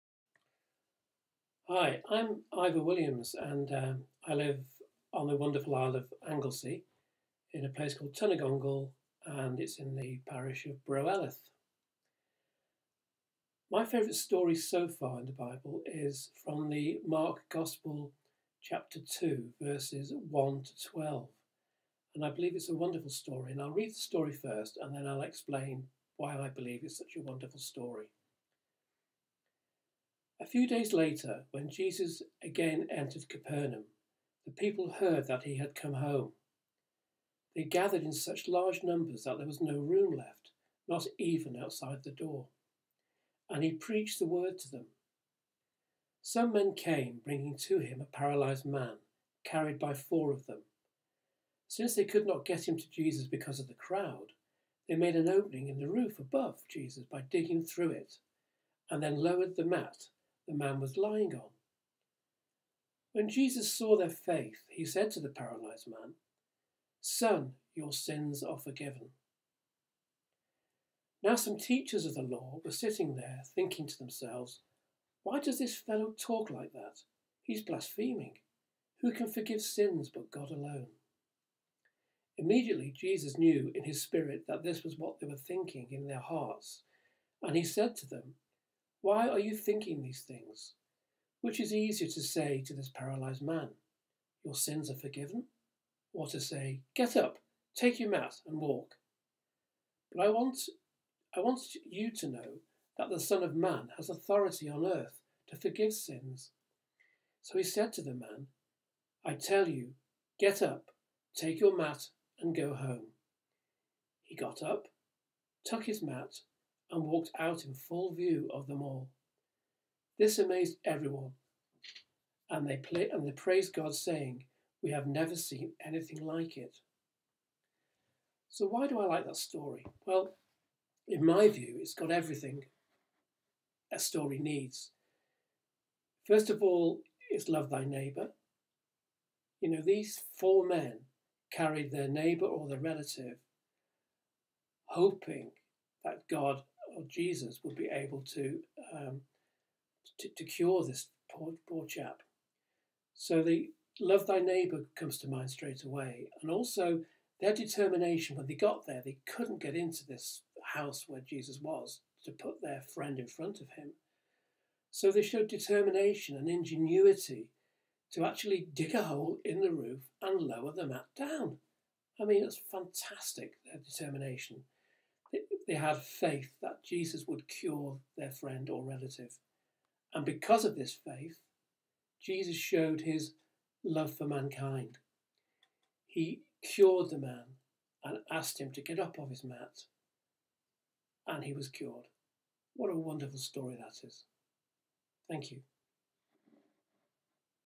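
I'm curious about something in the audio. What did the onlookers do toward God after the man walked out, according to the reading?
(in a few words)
Praised God.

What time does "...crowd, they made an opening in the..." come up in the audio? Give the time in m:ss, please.
0:53.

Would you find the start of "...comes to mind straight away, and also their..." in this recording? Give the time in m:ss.
2:34.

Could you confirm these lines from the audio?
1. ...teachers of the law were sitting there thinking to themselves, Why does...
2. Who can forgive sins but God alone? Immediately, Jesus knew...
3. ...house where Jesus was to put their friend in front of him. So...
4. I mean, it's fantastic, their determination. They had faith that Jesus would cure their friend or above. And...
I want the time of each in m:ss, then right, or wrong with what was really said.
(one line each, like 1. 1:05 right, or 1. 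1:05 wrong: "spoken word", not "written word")
1. 1:11 right
2. 1:19 right
3. 2:40 right
4. 2:52 wrong: "relative", not "above".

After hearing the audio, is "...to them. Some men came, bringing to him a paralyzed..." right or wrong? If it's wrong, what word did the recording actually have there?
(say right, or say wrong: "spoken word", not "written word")
right.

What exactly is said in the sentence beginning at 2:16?
First of all, it's love thy neighbour.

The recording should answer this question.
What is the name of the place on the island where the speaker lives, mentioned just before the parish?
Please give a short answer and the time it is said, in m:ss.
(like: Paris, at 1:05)
Tynygongl, at 0:08.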